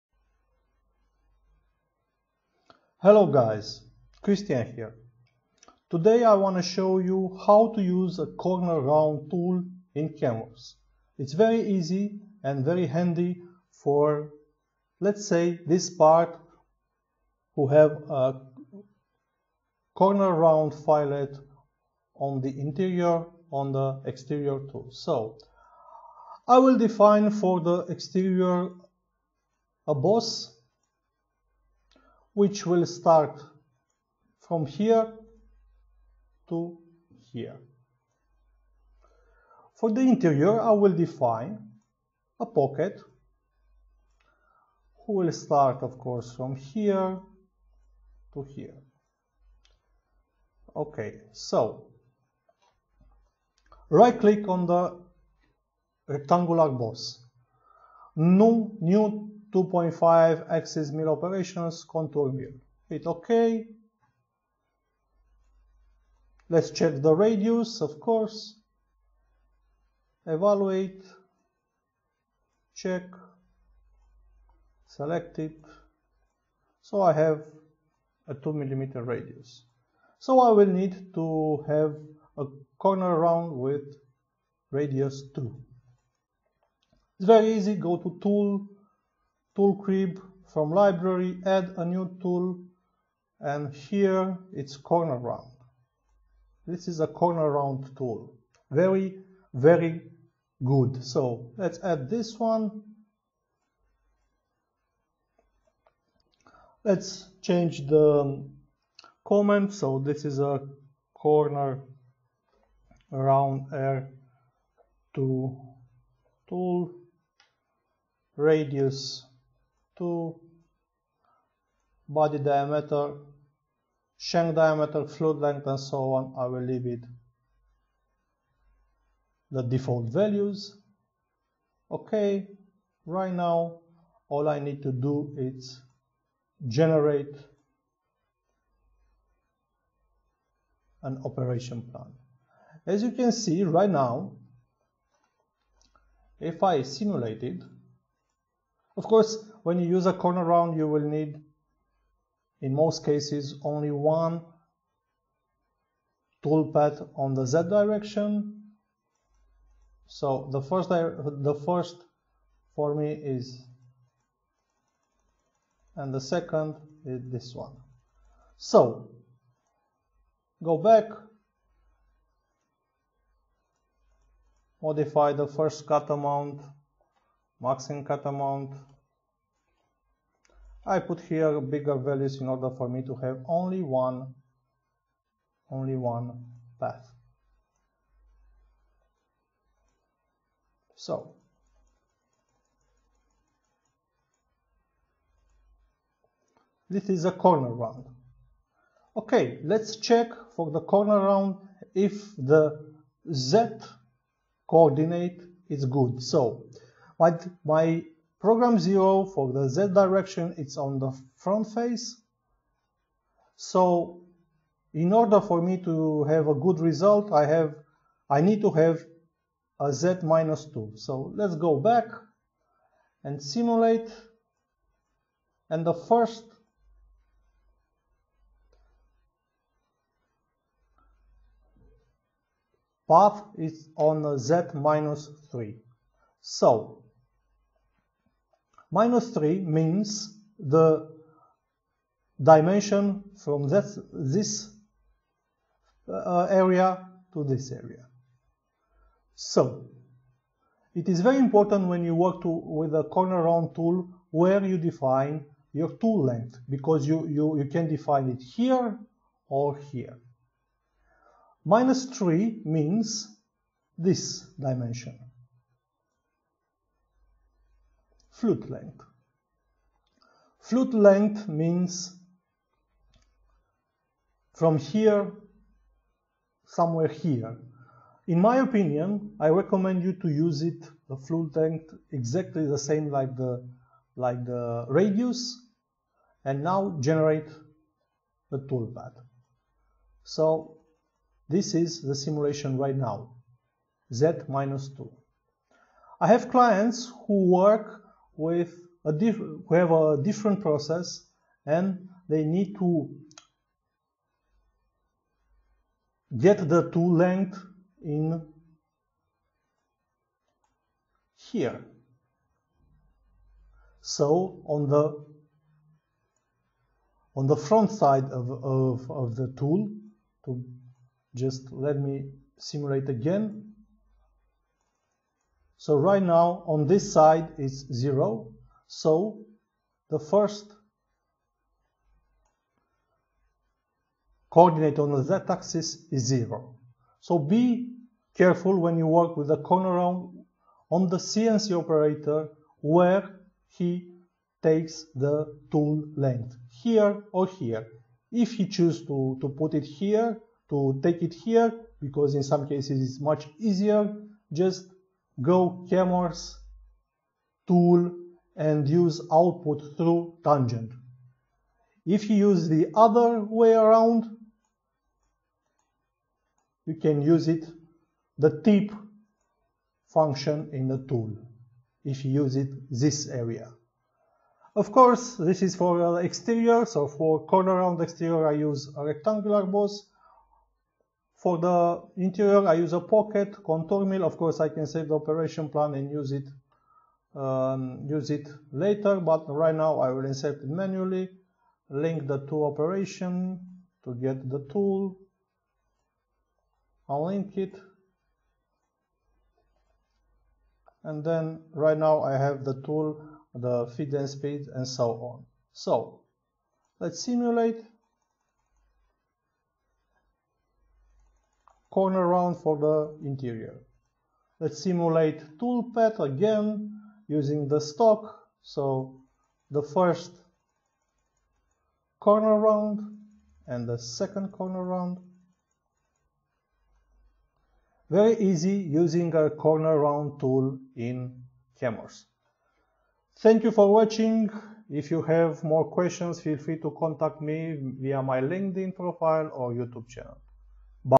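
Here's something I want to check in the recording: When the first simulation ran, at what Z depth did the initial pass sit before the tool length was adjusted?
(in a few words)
Z minus 3.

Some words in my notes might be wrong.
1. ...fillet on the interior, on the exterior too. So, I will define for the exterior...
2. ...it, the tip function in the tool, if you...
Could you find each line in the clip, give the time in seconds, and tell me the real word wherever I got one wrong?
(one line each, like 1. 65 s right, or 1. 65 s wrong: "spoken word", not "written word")
1. 20 s right
2. 367 s right.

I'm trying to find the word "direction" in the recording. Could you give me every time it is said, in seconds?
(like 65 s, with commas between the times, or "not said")
157 s, 209 s.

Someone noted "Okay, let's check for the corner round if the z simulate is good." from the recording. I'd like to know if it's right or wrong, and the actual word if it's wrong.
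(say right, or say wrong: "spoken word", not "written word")
wrong: "coordinate", not "simulate".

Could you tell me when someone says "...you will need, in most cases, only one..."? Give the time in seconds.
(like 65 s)
150 s.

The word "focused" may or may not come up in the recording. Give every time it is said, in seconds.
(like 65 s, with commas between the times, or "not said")
not said.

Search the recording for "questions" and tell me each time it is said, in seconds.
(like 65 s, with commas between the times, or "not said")
435 s.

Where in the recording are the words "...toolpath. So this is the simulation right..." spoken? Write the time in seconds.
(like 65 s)
288 s.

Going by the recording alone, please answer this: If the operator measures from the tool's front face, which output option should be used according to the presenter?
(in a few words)
Output through tangent.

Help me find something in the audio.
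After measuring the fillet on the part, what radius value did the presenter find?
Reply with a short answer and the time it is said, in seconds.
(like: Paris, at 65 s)
2 millimeter, at 78 s.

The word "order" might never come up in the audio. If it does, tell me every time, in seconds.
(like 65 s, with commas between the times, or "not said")
182 s, 215 s.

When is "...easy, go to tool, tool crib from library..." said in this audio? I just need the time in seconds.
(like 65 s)
87 s.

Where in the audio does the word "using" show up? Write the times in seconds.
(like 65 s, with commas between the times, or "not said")
417 s, 428 s.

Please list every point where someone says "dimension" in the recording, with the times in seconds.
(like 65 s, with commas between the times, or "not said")
242 s, 264 s.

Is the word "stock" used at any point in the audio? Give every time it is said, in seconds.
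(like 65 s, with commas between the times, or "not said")
417 s.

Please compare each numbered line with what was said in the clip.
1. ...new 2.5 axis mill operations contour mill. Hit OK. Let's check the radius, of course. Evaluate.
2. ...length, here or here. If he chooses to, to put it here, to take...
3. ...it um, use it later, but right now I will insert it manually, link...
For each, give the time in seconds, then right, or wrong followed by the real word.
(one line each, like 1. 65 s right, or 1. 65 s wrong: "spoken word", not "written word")
1. 58 s right
2. 346 s right
3. 386 s right.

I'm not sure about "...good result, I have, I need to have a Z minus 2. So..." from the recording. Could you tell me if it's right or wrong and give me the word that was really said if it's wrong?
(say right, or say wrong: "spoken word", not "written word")
right.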